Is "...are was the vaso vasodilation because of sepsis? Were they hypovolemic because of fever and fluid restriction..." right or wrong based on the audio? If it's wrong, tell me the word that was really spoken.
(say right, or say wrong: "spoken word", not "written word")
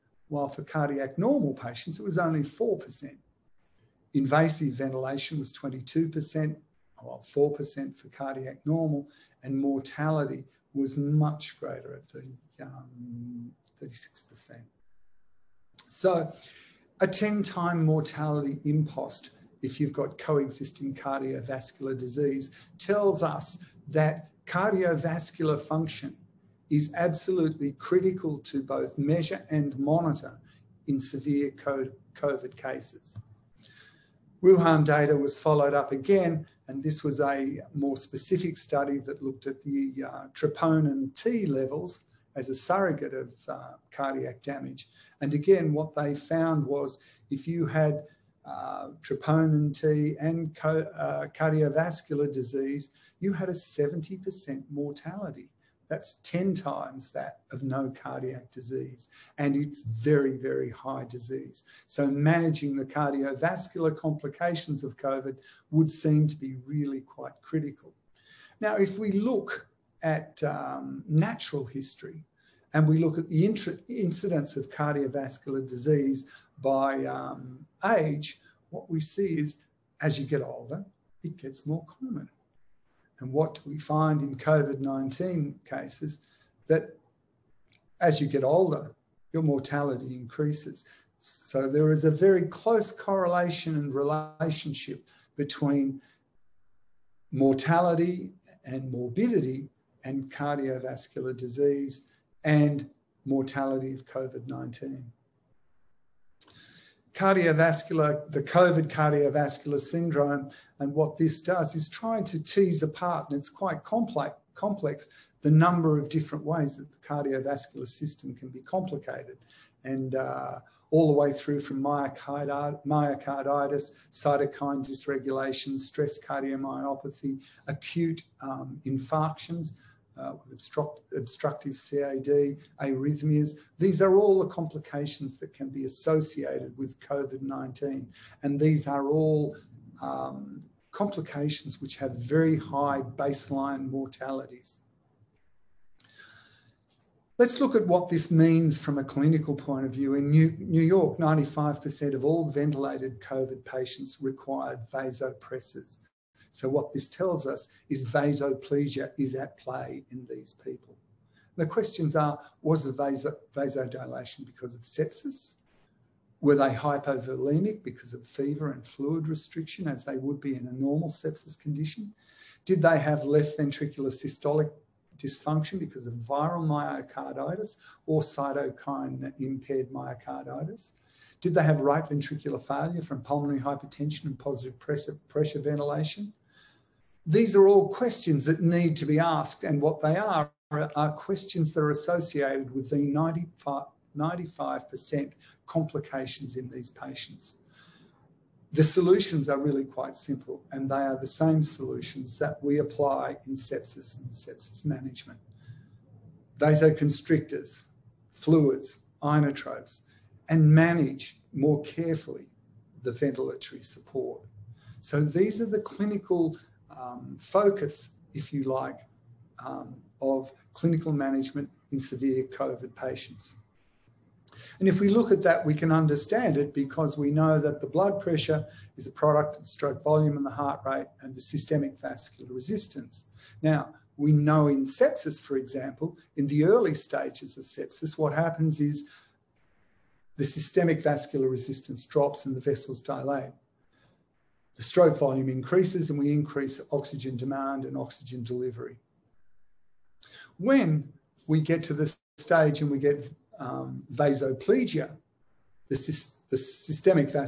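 right.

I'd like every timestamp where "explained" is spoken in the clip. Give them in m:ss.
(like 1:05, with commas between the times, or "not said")
not said.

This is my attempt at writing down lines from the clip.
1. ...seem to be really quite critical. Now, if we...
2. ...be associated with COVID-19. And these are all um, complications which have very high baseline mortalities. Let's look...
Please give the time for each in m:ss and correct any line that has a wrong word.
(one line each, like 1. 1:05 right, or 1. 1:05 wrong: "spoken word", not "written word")
1. 1:05 right
2. 2:15 right.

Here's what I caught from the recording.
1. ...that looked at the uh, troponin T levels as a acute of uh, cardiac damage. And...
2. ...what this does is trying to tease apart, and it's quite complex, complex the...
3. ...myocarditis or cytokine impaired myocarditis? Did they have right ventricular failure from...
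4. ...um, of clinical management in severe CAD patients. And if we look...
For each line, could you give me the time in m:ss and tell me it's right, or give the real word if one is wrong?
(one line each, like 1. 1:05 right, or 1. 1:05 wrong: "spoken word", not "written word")
1. 0:38 wrong: "surrogate", not "acute"
2. 1:50 right
3. 2:56 right
4. 3:39 wrong: "COVID", not "CAD".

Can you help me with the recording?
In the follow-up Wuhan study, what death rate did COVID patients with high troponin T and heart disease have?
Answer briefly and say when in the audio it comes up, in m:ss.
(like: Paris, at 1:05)
70%, at 0:53.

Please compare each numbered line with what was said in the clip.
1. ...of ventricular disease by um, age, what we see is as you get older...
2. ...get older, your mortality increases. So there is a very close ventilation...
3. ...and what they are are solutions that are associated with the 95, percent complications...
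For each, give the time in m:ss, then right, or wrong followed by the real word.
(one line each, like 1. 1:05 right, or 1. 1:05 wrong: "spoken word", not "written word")
1. 1:14 wrong: "cardiovascular", not "ventricular"
2. 1:28 wrong: "correlation", not "ventilation"
3. 3:09 wrong: "questions", not "solutions".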